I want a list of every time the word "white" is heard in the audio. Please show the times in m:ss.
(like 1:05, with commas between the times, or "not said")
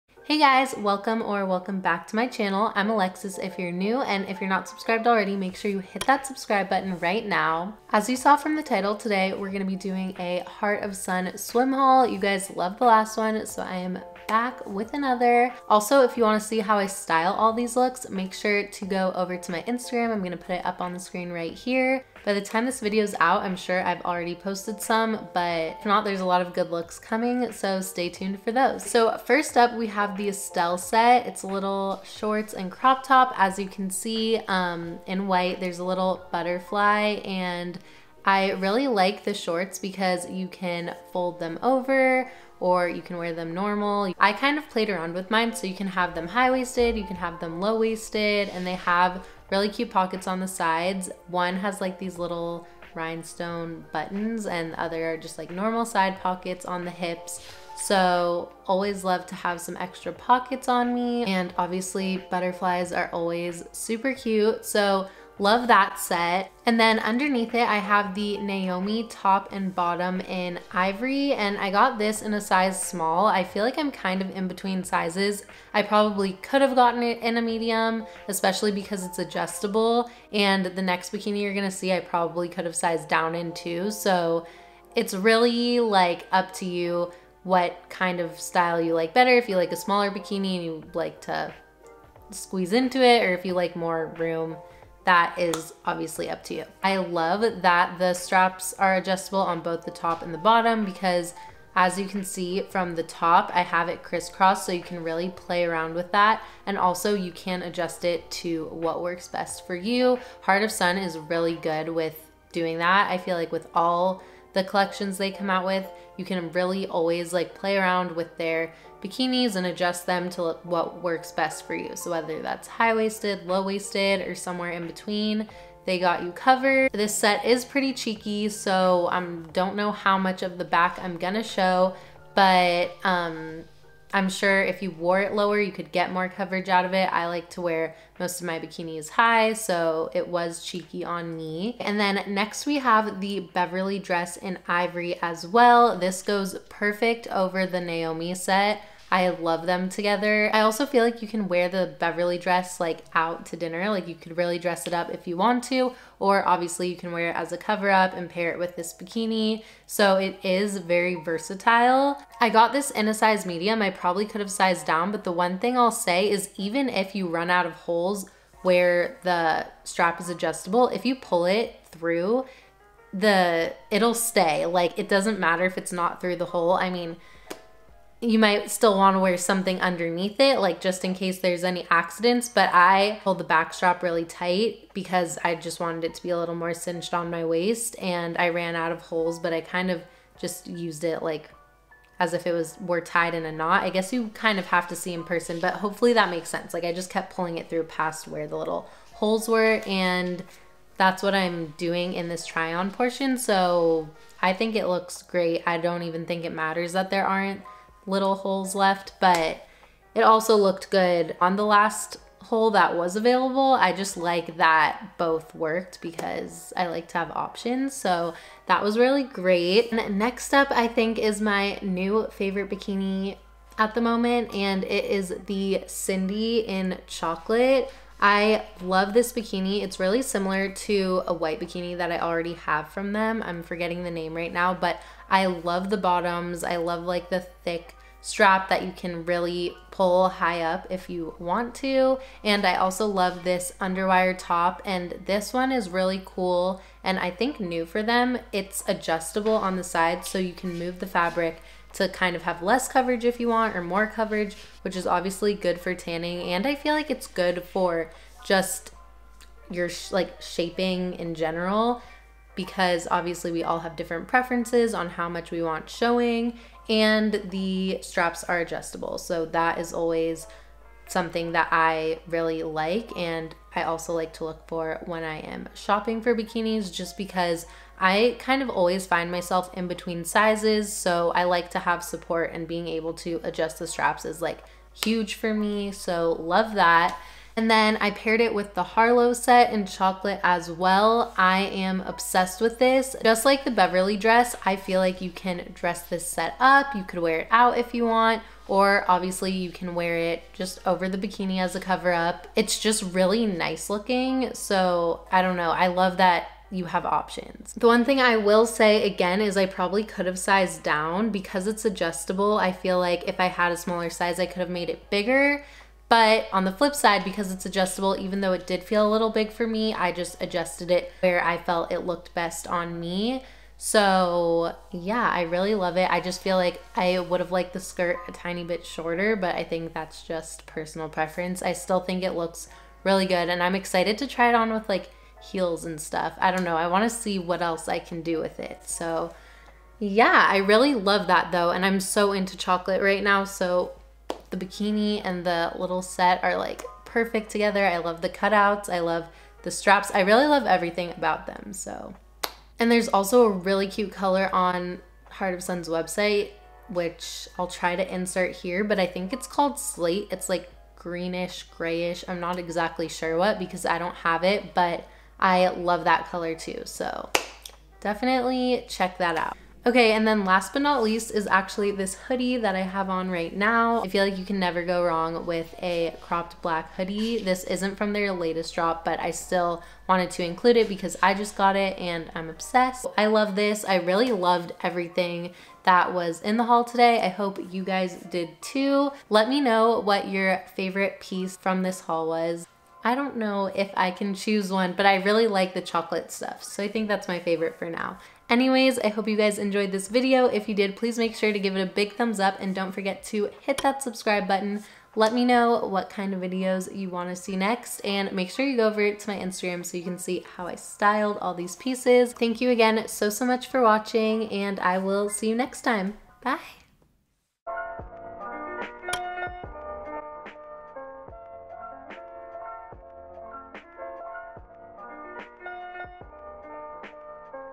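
0:35, 3:51.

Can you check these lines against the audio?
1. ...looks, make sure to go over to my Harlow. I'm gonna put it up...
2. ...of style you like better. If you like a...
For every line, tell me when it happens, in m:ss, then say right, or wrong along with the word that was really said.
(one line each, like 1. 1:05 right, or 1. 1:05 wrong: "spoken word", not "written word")
1. 0:17 wrong: "Instagram", not "Harlow"
2. 1:28 right.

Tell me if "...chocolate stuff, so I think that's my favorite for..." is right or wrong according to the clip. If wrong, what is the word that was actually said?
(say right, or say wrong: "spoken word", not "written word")
right.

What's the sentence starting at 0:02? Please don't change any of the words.
I'm Alexis if you're new, and if you're not subscribed already, make sure you hit that subscribe button right now.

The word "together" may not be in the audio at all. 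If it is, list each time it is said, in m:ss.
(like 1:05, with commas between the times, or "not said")
2:29, 5:47.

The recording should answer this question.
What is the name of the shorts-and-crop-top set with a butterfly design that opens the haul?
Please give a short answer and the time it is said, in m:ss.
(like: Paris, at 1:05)
Estelle, at 0:30.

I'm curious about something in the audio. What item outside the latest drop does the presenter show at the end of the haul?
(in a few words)
cropped black hoodie.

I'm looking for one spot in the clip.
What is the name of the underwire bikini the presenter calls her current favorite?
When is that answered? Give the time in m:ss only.
3:45.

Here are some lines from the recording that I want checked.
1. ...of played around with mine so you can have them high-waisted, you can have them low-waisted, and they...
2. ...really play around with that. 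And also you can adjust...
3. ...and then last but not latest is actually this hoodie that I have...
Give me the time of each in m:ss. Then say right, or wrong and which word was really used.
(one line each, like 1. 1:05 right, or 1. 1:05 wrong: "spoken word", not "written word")
1. 0:44 right
2. 1:45 right
3. 6:10 wrong: "least", not "latest".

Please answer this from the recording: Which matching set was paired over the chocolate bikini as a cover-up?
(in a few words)
Harlow.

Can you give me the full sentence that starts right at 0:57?
So always love to have some extra pockets on me and obviously butterflies are always super cute.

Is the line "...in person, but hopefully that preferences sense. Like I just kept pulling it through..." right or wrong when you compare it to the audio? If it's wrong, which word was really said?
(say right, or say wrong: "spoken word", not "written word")
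wrong: "makes", not "preferences".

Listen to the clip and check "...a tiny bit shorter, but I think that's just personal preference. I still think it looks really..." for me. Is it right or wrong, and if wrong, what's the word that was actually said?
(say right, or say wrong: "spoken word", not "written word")
right.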